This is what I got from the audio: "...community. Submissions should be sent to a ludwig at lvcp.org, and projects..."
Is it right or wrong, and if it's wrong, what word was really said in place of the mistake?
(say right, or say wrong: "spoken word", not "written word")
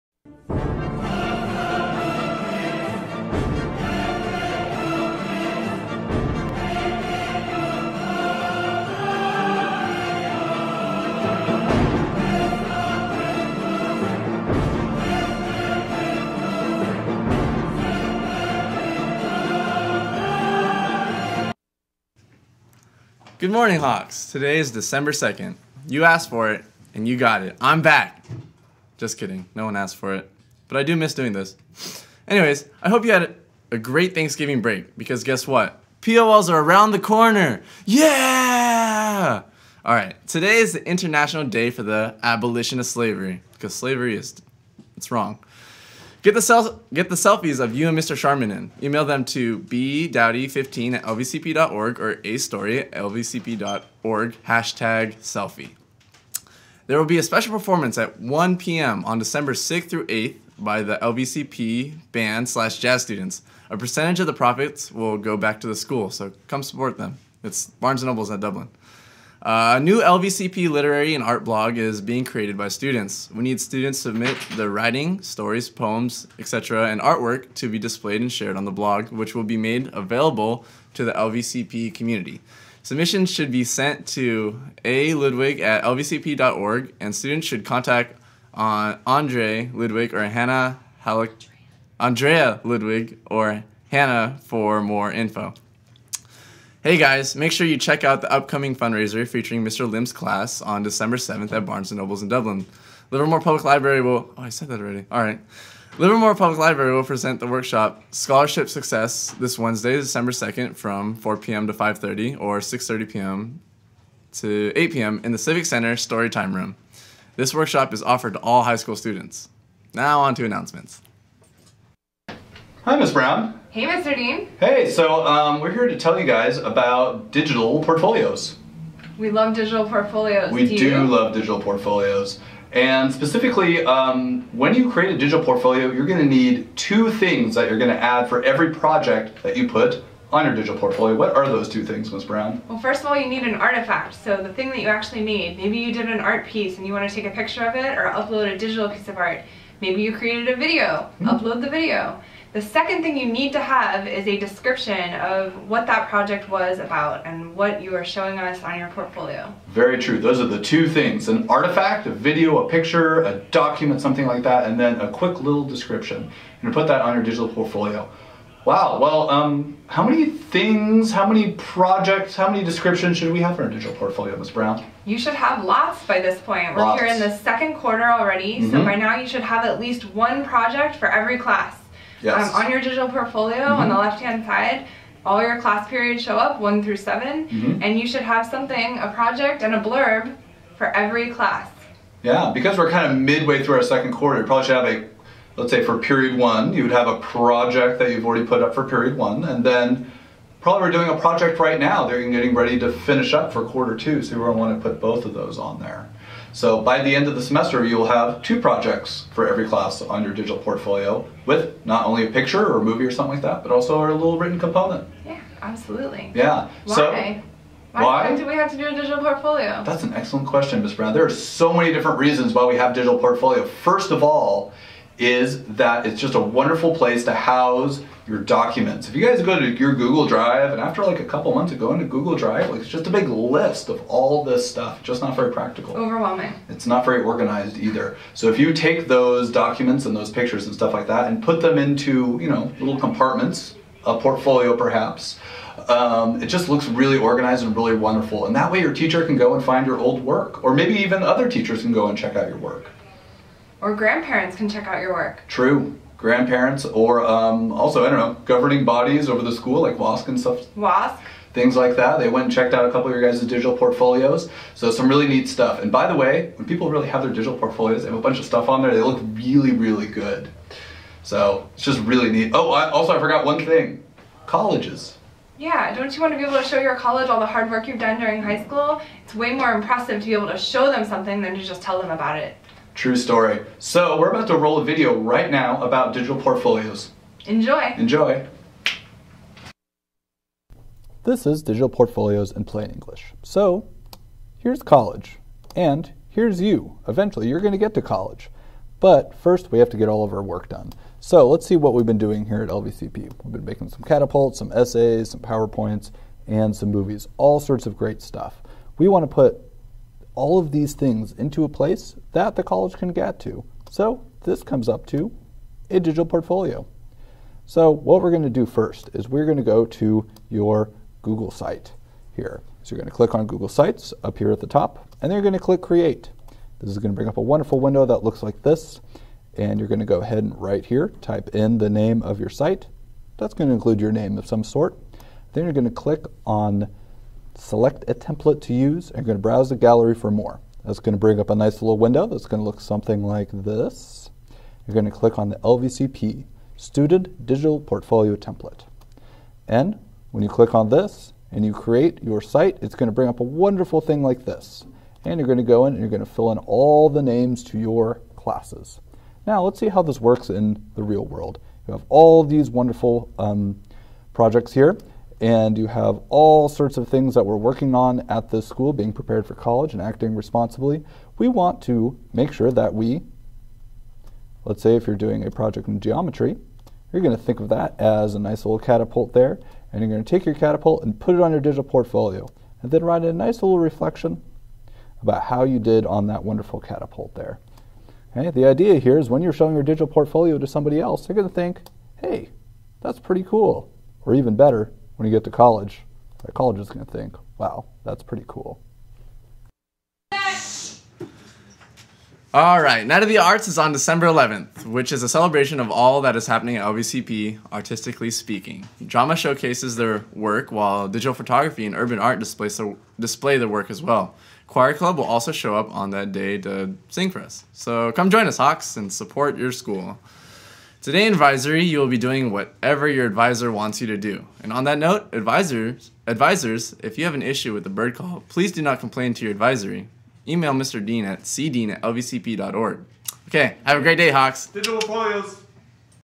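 wrong: "students", not "projects".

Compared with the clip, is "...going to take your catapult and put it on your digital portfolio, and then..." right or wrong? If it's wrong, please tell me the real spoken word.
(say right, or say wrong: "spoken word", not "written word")
right.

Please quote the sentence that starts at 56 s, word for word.
There will be a special performance at 1 p.m.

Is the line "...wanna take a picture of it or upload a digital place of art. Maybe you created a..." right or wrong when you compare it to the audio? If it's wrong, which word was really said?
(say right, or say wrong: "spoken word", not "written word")
wrong: "piece", not "place".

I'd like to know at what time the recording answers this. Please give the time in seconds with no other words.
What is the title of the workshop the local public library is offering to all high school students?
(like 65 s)
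108 s.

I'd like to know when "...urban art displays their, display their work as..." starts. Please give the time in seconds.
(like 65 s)
411 s.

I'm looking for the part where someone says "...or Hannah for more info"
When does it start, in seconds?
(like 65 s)
93 s.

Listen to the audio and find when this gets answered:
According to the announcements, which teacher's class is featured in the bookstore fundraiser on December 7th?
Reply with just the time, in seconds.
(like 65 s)
99 s.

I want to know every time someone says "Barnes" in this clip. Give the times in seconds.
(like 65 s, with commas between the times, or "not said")
67 s, 101 s.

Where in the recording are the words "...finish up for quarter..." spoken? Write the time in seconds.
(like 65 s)
202 s.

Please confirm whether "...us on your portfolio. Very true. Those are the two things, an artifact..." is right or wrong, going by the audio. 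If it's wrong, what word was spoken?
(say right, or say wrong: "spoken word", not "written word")
right.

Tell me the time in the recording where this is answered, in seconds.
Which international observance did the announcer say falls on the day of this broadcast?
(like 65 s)
40 s.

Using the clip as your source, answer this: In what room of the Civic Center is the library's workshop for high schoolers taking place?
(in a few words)
Storytime Room.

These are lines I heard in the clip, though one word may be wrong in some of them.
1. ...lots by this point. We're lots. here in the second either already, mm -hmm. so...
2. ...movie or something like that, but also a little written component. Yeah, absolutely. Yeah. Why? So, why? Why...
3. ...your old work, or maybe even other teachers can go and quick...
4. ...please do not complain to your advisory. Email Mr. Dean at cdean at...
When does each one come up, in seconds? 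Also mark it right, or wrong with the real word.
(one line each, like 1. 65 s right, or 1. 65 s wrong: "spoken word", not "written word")
1. 175 s wrong: "quarter", not "either"
2. 212 s right
3. 249 s wrong: "check", not "quick"
4. 428 s right.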